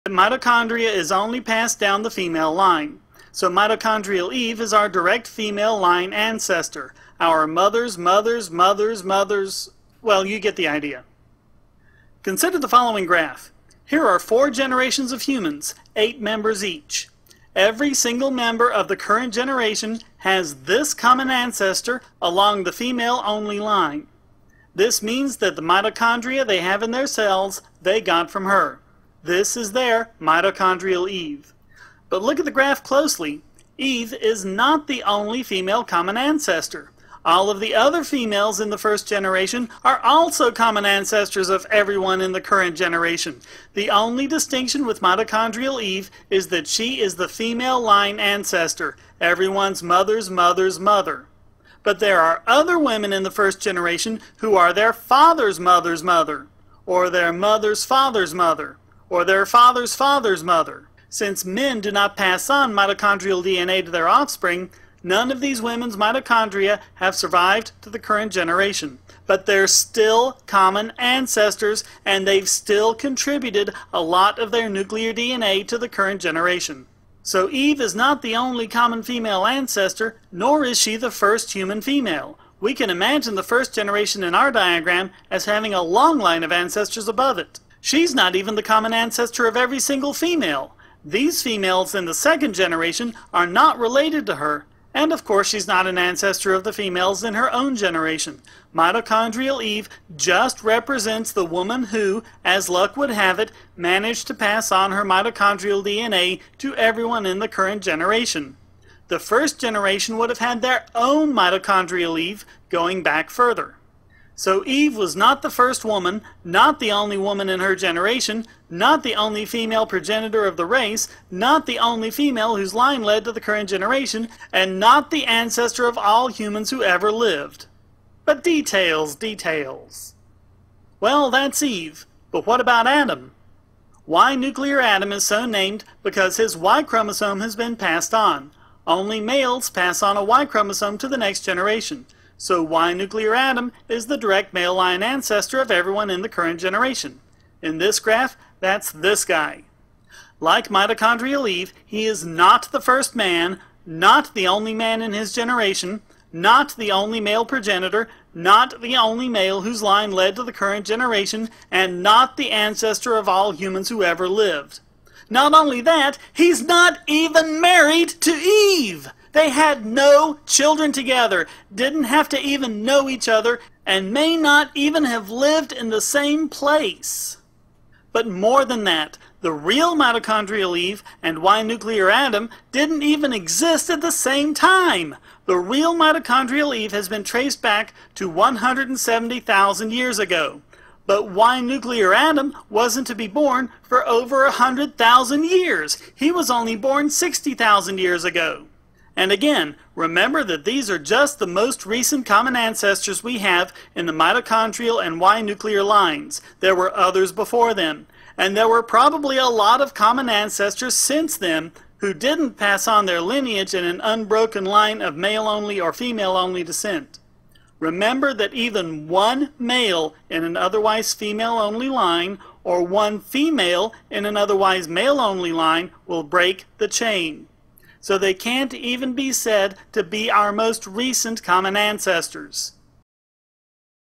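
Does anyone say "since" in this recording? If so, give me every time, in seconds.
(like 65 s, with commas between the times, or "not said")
61 s, 210 s.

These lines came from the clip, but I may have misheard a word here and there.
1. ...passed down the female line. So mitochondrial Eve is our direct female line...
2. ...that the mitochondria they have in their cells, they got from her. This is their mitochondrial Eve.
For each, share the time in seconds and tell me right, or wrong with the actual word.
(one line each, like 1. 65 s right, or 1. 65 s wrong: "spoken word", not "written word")
1. 1 s right
2. 25 s right.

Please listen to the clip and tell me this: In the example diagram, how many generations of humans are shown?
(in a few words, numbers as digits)
4.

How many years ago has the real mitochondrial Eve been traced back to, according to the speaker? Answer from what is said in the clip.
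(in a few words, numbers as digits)
170,000 years ago.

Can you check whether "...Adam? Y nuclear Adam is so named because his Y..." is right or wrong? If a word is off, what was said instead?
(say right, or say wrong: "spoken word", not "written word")
right.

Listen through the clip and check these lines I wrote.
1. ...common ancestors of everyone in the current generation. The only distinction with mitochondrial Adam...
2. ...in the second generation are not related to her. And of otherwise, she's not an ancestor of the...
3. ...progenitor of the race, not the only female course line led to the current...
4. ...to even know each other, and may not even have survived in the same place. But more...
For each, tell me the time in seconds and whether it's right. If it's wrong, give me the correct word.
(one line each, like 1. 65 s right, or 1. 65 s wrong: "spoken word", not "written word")
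1. 40 s wrong: "Eve", not "Adam"
2. 91 s wrong: "course", not "otherwise"
3. 119 s wrong: "whose", not "course"
4. 172 s wrong: "lived", not "survived".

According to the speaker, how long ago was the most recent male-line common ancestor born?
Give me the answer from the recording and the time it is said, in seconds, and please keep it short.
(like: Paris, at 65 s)
60,000 years ago, at 197 s.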